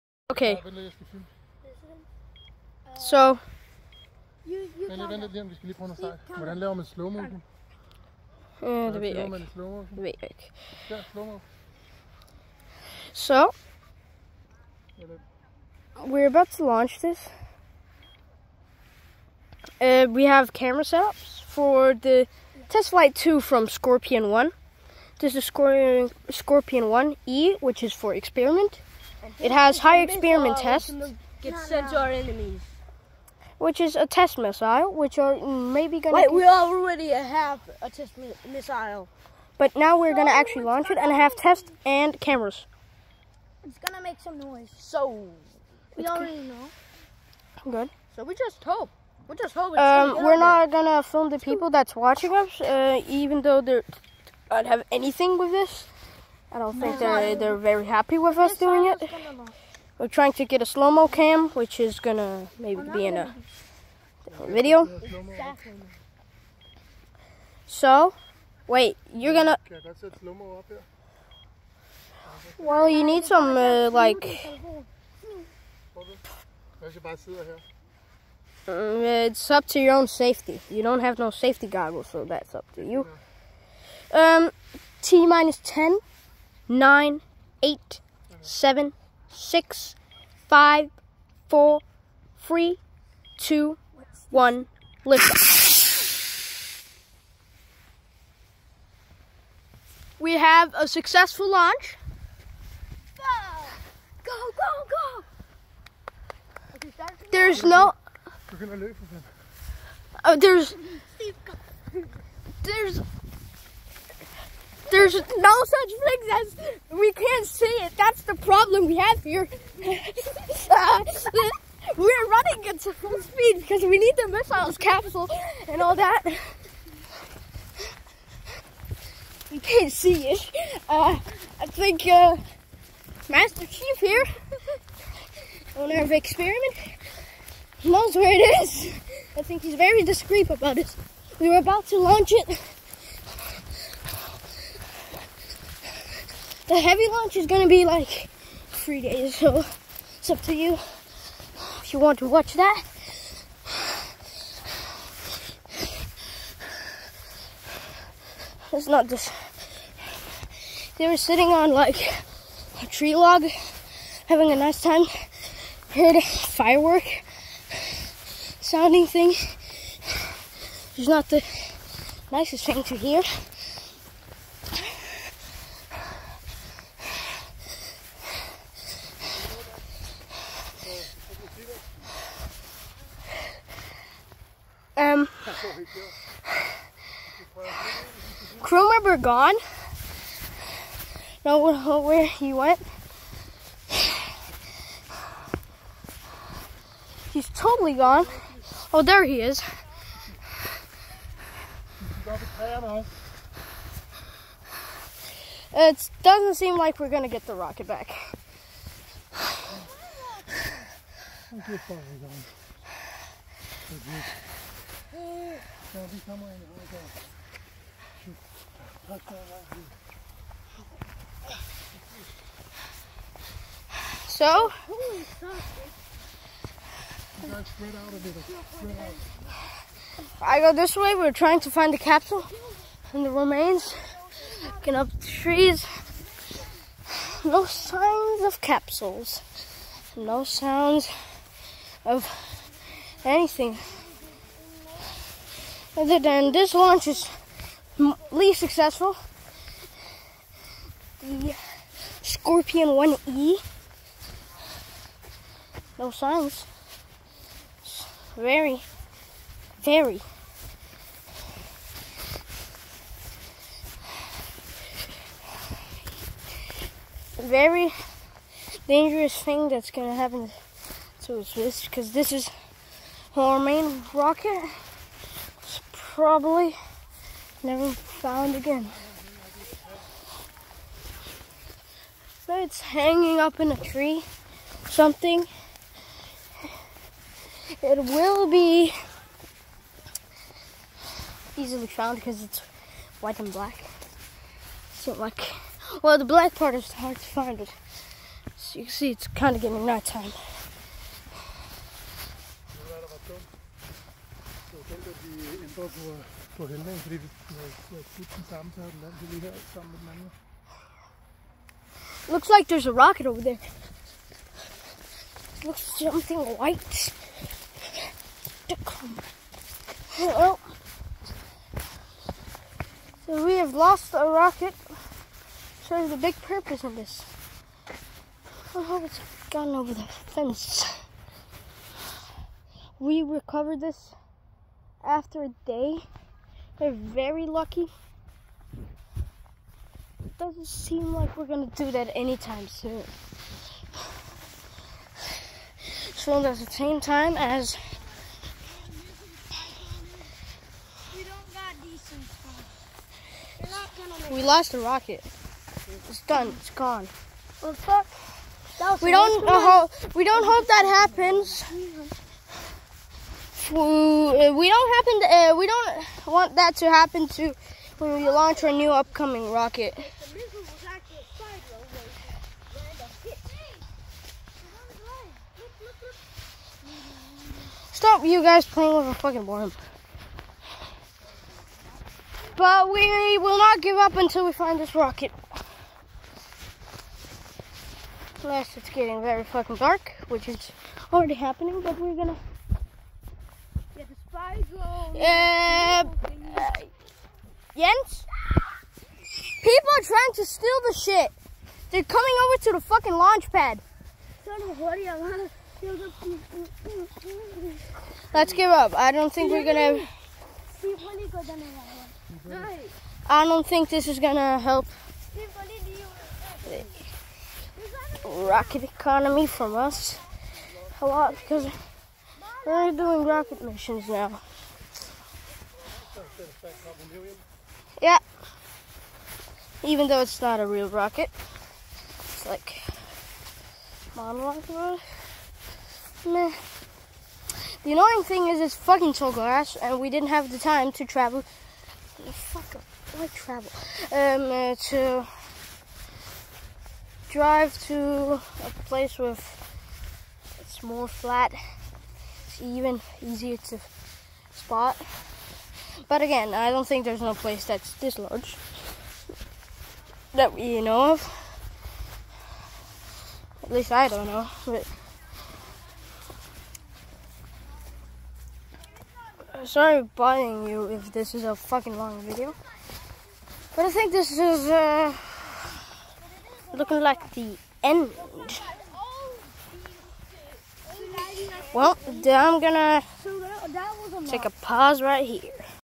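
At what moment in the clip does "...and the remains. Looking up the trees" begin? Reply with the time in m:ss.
3:53.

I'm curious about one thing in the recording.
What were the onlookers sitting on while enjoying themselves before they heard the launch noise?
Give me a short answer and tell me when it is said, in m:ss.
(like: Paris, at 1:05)
a tree log, at 2:42.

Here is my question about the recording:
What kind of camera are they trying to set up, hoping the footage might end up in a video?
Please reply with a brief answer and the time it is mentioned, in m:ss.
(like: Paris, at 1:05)
slow-mo cam, at 1:00.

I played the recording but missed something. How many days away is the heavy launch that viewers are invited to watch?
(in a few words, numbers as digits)
3.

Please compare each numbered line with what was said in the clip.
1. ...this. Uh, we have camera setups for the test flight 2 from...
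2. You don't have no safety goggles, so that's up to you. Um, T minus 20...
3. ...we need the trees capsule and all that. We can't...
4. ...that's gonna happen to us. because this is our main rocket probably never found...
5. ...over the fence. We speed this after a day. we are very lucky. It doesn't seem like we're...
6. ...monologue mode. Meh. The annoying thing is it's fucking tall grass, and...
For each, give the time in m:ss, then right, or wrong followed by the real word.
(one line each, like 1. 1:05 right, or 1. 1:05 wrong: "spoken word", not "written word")
1. 0:16 right
2. 1:20 wrong: "10", not "20"
3. 2:03 wrong: "missiles", not "trees"
4. 4:29 right
5. 5:29 wrong: "recovered", not "speed"
6. 7:14 right.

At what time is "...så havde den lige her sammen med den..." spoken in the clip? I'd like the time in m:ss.
5:08.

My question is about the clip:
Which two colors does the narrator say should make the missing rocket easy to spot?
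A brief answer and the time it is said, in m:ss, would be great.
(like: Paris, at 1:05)
white and black, at 4:53.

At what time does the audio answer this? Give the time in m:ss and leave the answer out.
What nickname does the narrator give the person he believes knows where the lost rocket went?
2:13.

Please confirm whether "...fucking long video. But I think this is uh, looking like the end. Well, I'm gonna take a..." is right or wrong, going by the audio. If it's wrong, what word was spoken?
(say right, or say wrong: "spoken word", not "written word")
right.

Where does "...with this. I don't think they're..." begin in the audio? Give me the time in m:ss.
0:55.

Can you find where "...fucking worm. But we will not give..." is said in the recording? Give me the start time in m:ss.
6:19.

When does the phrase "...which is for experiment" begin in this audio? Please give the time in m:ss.
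0:27.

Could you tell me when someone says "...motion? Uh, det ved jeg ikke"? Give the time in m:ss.
0:07.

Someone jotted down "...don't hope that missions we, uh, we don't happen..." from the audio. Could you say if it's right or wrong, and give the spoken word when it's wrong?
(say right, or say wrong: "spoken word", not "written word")
wrong: "happens", not "missions".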